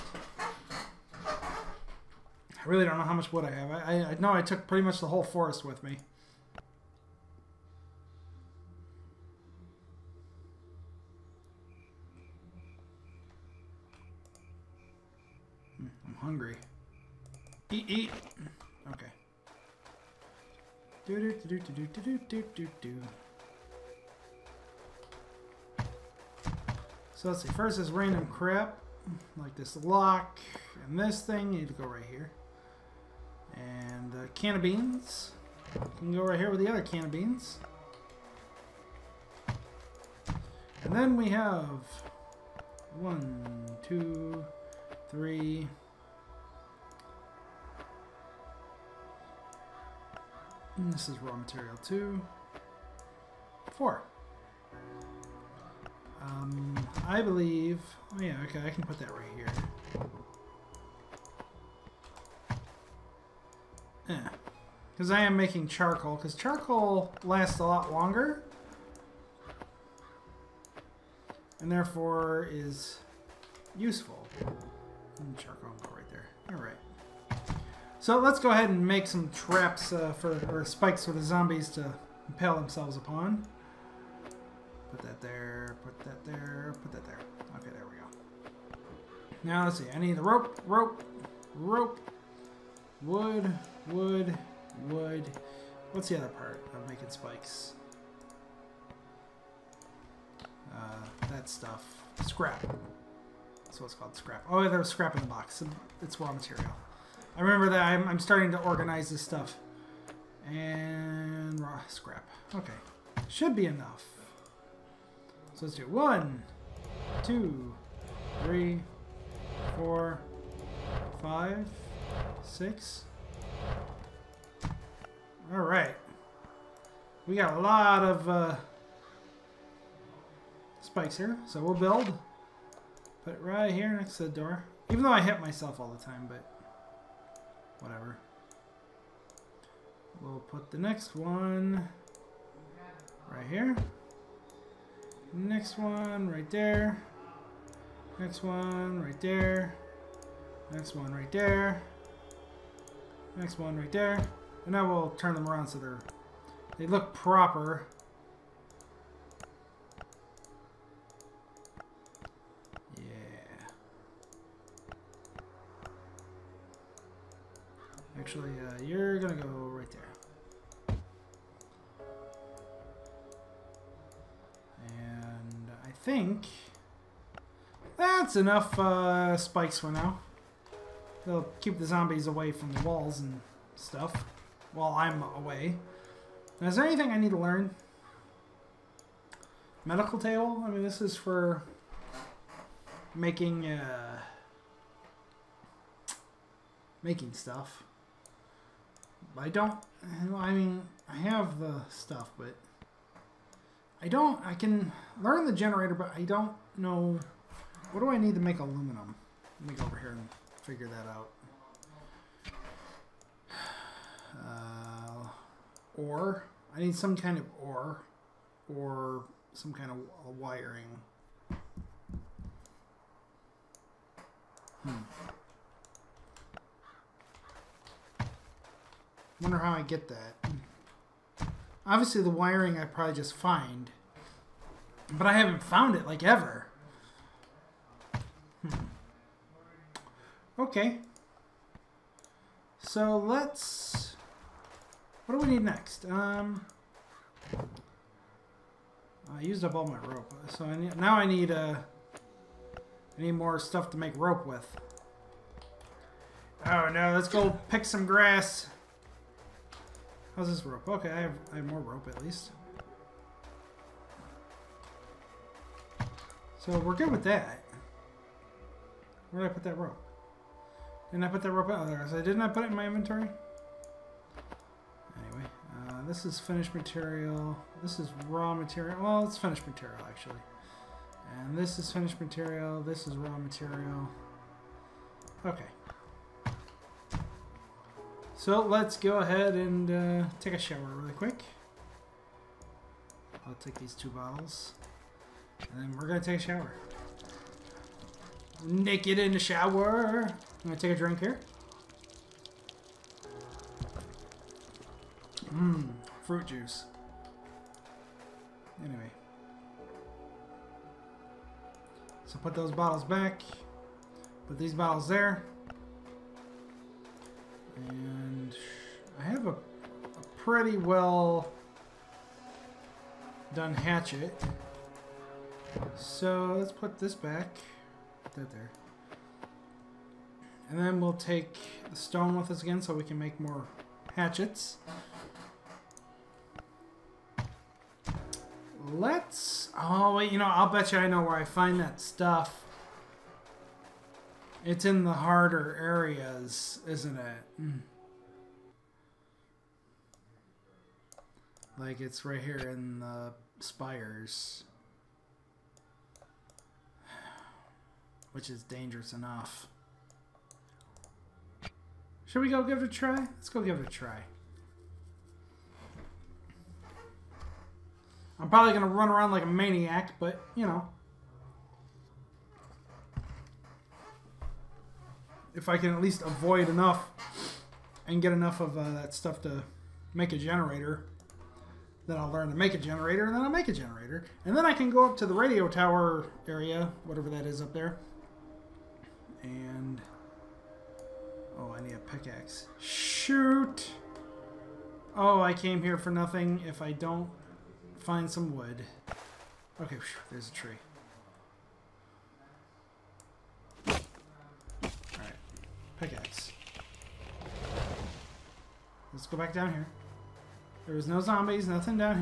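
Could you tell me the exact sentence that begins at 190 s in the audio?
I mean, this is for making, uh, making stuff.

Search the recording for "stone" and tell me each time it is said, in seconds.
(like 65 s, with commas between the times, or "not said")
331 s.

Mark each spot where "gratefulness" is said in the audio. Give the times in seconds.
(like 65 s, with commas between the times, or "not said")
not said.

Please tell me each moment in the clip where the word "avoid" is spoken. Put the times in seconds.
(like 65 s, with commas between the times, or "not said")
376 s.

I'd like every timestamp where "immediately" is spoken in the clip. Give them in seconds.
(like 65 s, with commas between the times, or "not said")
not said.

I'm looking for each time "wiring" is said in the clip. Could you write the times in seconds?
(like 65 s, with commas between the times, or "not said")
220 s, 232 s.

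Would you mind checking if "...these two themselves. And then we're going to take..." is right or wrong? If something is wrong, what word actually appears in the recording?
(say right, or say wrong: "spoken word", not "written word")
wrong: "bottles", not "themselves".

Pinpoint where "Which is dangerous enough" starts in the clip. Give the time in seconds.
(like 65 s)
358 s.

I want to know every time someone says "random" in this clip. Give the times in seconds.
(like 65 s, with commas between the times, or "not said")
27 s.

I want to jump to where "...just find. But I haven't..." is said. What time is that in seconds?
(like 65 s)
233 s.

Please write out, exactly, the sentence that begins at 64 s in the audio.
Because I am making charcoal, because charcoal lasts a lot longer.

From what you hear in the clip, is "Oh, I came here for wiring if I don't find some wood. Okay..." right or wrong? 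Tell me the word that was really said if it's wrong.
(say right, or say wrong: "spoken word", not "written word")
wrong: "nothing", not "wiring".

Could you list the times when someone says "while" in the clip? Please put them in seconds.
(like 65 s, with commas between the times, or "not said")
184 s.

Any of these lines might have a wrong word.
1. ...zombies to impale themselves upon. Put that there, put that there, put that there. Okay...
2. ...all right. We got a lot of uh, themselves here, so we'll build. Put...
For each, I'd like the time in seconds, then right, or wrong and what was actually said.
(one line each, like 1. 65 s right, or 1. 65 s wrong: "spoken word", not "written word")
1. 81 s right
2. 125 s wrong: "spikes", not "themselves".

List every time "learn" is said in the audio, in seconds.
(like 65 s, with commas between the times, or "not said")
187 s, 205 s, 382 s.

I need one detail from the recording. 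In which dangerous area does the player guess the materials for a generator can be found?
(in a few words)
The spires.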